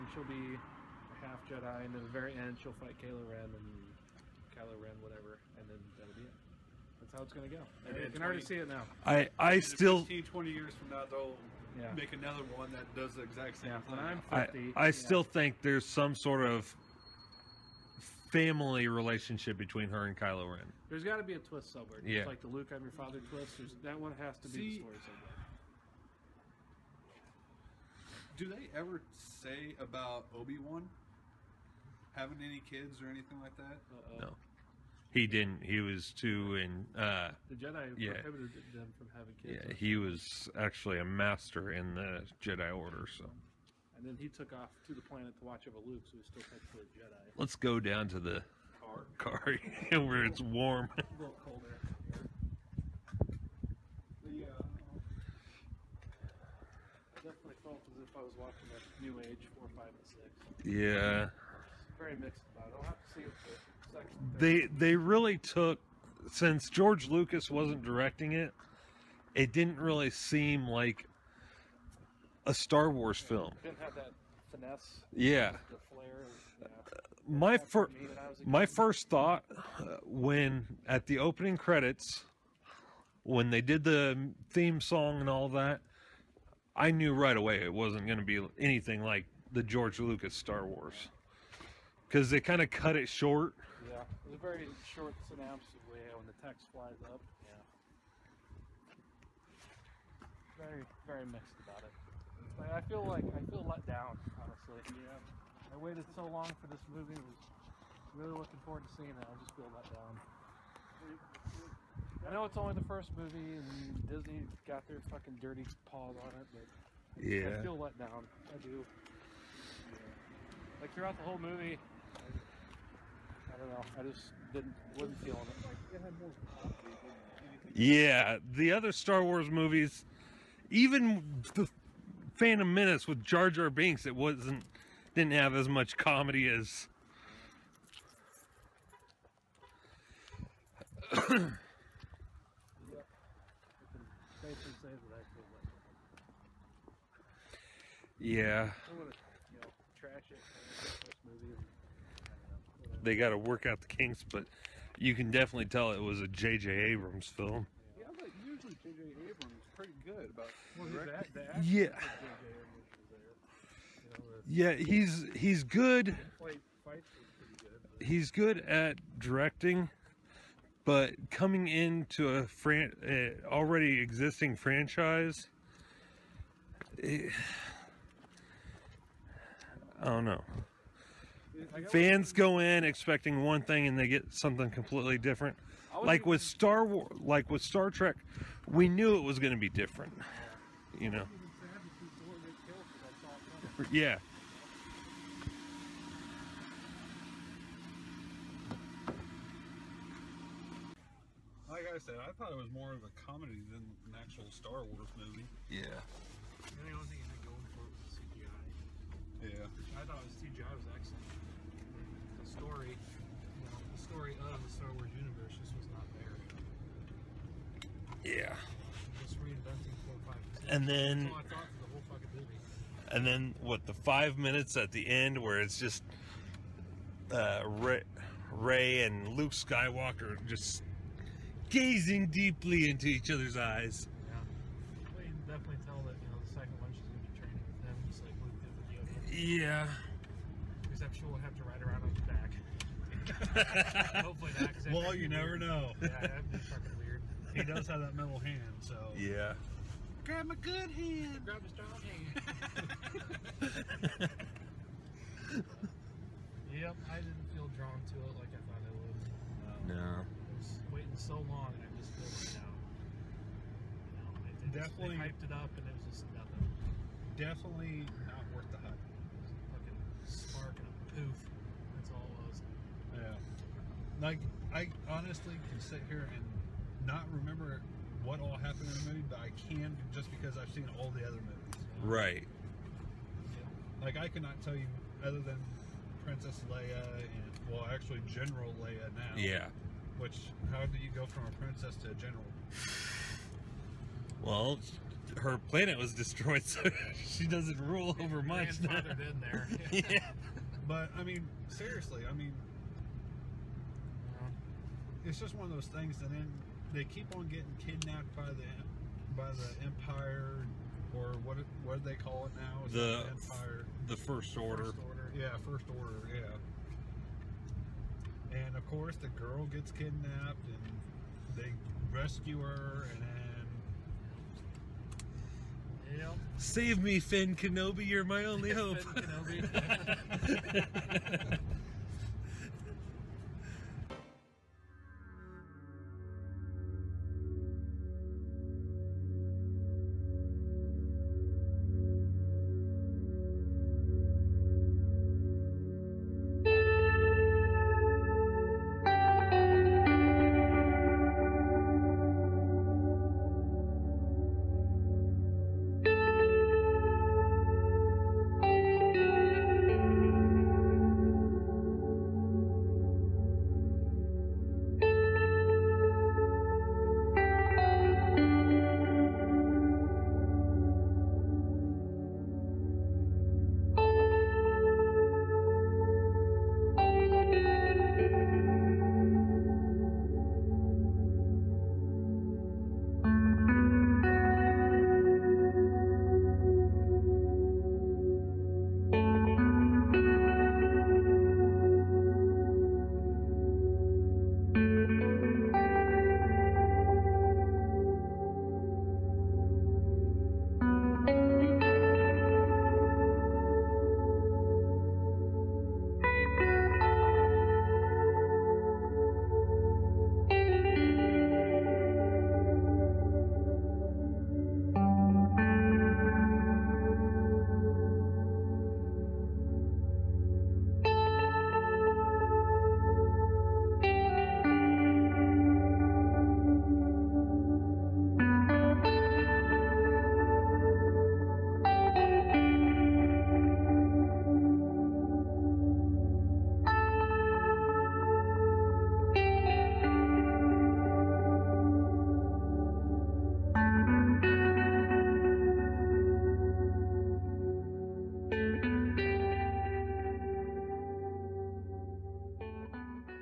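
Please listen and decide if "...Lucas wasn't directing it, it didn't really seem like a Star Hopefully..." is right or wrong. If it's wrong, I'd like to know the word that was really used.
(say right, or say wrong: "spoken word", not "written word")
wrong: "Wars", not "Hopefully".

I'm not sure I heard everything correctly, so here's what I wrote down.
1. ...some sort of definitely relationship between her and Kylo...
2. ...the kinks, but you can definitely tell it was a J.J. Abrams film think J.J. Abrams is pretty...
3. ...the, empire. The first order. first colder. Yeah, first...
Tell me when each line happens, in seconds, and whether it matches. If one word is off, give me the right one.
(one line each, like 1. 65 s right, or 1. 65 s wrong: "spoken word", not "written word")
1. 15 s wrong: "family", not "definitely"
2. 153 s right
3. 312 s wrong: "order", not "colder".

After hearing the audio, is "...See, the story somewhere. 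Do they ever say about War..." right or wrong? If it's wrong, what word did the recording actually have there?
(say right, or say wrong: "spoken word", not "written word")
wrong: "Obi", not "War".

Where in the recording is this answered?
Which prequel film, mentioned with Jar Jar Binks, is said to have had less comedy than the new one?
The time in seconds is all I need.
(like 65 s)
132 s.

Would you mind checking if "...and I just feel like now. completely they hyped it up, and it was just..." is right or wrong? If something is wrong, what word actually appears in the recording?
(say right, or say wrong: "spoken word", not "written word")
wrong: "definitely", not "completely".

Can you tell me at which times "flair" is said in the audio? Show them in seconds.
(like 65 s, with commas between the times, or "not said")
75 s.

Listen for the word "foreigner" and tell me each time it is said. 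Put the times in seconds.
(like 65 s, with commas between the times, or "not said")
not said.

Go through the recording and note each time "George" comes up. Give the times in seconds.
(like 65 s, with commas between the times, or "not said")
66 s, 89 s.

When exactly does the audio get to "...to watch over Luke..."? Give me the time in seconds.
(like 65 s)
45 s.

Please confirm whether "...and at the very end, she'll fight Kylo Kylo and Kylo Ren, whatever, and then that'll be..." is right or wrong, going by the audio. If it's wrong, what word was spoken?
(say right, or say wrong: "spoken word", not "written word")
wrong: "Ren", not "Kylo".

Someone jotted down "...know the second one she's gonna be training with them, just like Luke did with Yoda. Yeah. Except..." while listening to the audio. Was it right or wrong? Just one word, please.
right.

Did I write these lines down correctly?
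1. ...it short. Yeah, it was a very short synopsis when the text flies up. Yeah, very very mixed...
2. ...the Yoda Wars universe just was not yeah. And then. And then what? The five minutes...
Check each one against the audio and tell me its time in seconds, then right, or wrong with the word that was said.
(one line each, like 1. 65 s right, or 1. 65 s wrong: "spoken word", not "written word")
1. 92 s right
2. 214 s wrong: "Star", not "Yoda".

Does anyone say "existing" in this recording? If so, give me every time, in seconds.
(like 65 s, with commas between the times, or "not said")
173 s.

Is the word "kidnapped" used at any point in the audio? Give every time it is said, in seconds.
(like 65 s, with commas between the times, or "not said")
307 s, 319 s.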